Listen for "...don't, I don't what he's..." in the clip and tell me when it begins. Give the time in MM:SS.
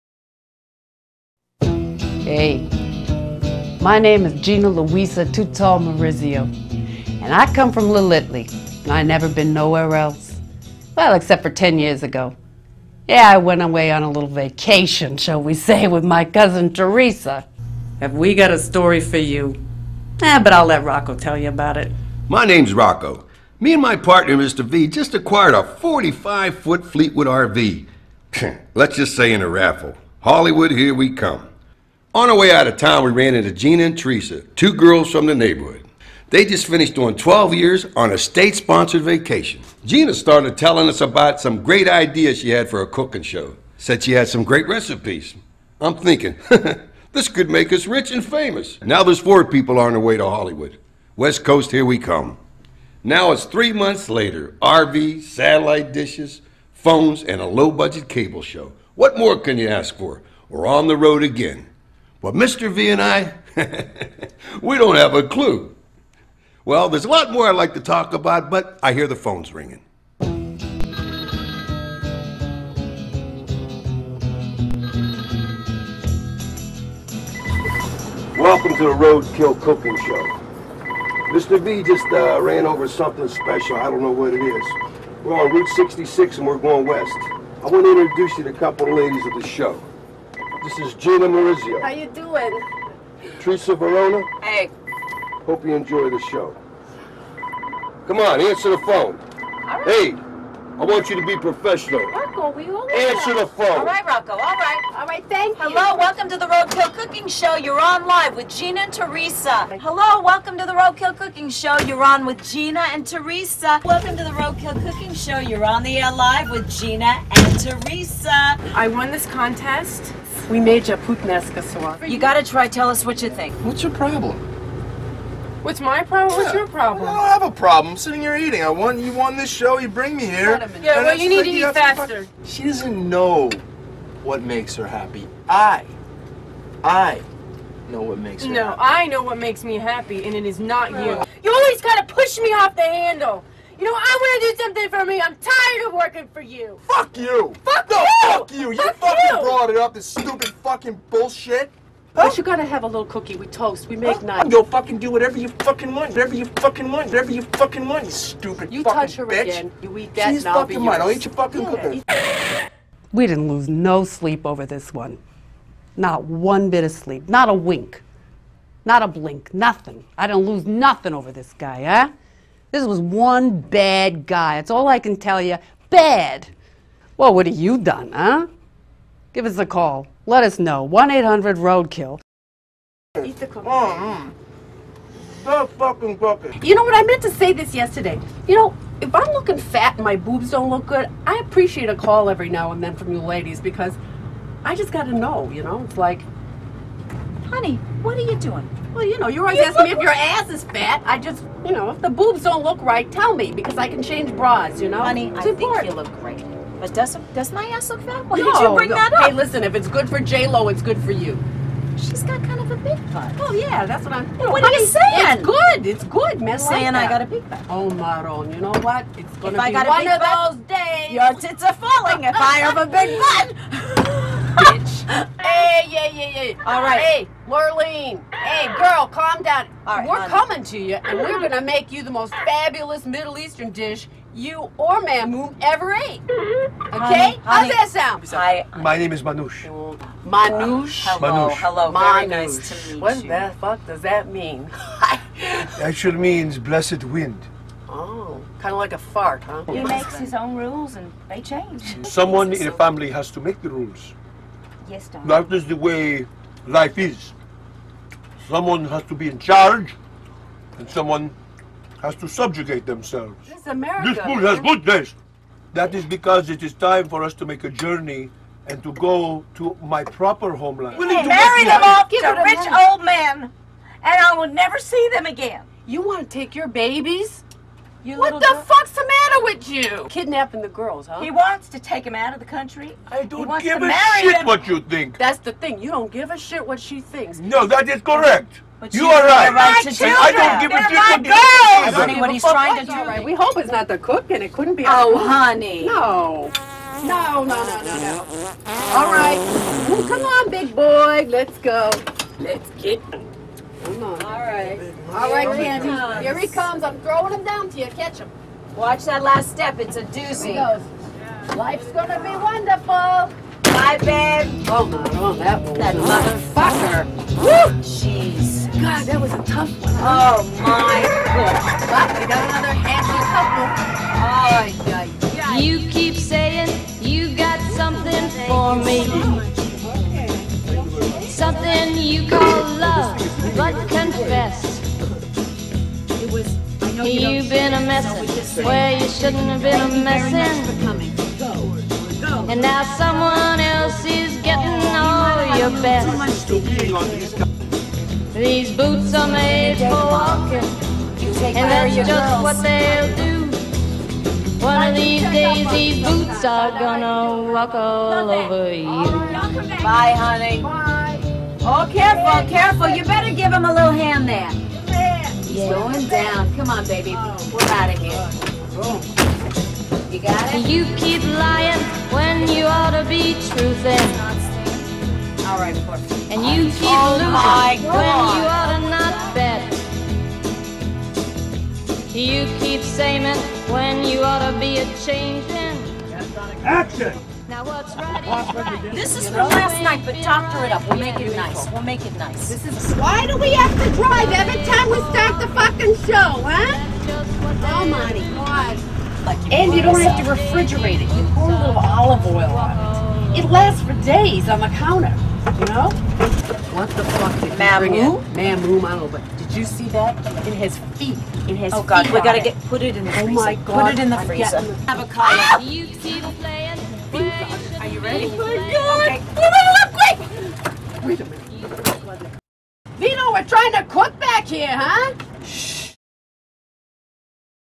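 04:51.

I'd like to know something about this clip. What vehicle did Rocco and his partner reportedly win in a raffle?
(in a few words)
45 foot Fleetwood RV.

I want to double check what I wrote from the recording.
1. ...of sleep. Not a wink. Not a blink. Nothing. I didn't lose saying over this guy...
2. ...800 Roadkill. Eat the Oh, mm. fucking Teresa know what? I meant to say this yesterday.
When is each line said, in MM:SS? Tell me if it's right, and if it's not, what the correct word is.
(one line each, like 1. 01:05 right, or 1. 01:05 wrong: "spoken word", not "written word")
1. 02:46 wrong: "nothing", not "saying"
2. 03:01 wrong: "You", not "Teresa".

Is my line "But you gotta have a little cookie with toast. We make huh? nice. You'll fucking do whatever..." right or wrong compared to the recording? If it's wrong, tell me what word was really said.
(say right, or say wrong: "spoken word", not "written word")
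right.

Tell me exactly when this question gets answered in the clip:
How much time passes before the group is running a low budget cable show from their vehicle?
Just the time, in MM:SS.
00:53.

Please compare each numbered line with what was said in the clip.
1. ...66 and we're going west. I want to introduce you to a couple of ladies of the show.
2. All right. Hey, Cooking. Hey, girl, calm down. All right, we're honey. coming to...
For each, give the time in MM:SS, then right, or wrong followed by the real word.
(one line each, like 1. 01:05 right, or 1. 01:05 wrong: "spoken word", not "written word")
1. 01:25 right
2. 03:46 wrong: "Lurleen", not "Cooking".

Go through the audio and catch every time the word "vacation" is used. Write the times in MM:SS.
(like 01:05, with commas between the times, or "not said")
00:14, 00:39.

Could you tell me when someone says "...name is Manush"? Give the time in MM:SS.
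03:58.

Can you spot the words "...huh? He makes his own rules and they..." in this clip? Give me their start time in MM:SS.
04:09.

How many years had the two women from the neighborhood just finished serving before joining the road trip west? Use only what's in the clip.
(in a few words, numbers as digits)
12.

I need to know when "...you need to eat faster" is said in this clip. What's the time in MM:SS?
02:11.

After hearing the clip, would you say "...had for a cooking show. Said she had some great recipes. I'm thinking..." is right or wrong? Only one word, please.
right.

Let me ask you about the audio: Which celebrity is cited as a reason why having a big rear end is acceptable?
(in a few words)
J Lo.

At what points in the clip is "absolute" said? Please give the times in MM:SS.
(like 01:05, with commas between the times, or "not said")
not said.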